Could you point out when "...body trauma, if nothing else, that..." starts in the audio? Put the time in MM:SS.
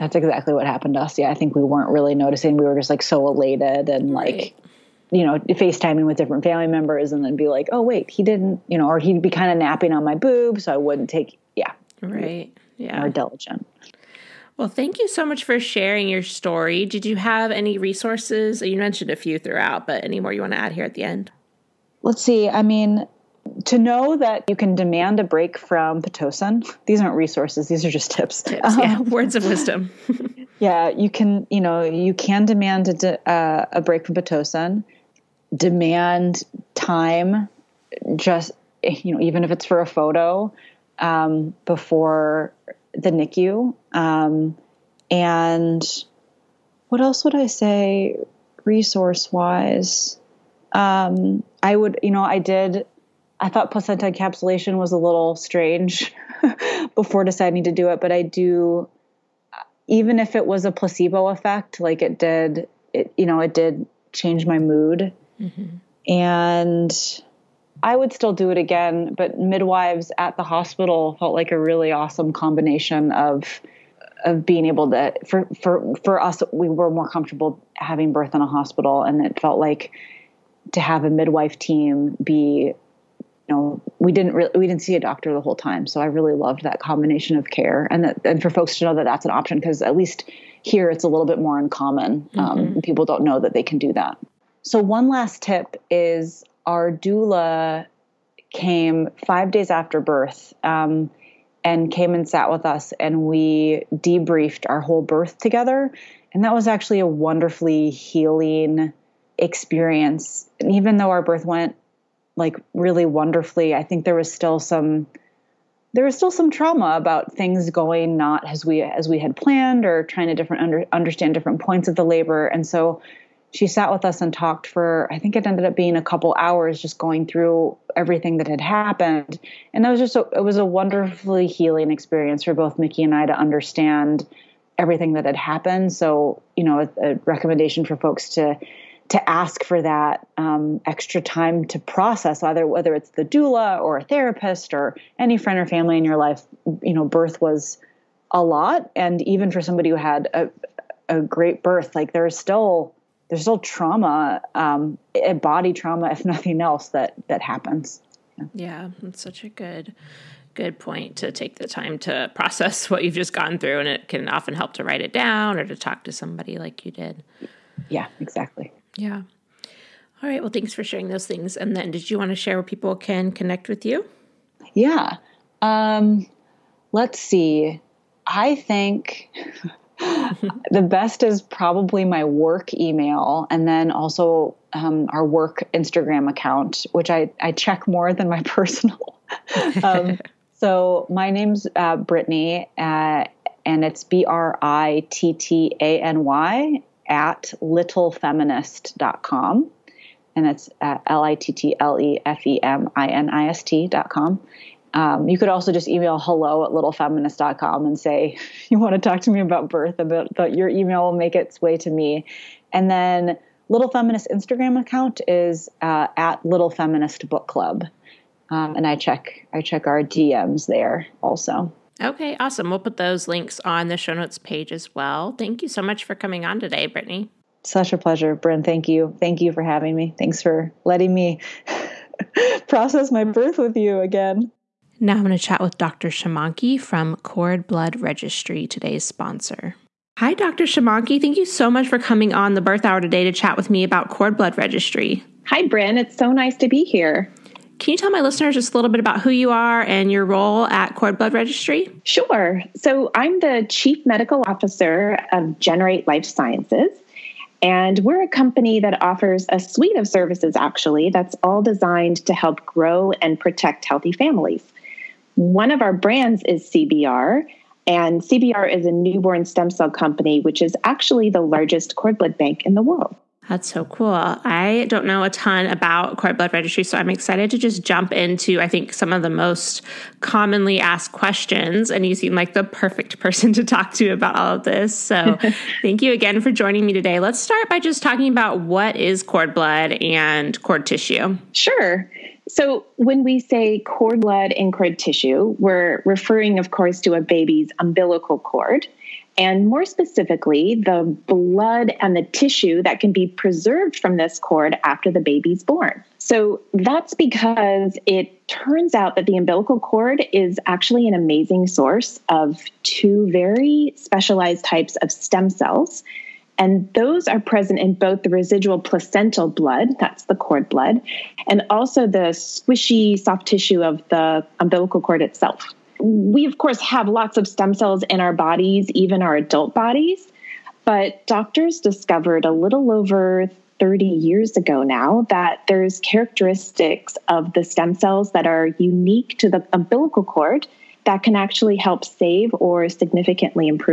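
02:35.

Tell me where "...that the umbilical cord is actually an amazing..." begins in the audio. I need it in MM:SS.
05:09.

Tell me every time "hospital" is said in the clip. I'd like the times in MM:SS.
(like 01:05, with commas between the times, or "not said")
01:10, 01:18.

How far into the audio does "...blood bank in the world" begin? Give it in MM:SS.
04:32.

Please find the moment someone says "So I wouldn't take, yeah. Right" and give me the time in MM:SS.
00:10.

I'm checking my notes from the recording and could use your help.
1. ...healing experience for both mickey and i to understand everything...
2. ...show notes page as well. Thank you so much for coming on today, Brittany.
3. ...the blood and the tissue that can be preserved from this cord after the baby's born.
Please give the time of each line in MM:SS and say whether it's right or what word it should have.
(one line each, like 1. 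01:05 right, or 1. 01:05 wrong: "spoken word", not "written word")
1. 02:11 right
2. 03:43 right
3. 05:00 right.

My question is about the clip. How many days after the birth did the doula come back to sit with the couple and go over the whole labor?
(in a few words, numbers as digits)
5.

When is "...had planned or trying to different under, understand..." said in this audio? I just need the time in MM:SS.
01:59.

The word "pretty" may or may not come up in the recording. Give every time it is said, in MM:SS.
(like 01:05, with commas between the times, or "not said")
not said.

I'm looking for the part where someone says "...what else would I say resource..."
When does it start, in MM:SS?
00:46.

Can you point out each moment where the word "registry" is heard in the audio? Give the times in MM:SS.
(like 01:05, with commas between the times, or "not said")
03:57, 04:04, 04:11, 04:36.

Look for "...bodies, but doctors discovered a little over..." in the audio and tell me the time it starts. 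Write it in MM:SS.
05:29.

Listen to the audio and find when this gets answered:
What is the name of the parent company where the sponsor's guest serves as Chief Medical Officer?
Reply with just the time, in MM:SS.
04:15.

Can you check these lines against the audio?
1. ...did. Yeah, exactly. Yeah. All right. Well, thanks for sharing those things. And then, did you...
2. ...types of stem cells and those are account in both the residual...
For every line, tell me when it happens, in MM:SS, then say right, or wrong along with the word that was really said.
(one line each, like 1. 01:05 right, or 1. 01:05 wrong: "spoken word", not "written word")
1. 02:46 right
2. 05:14 wrong: "present", not "account".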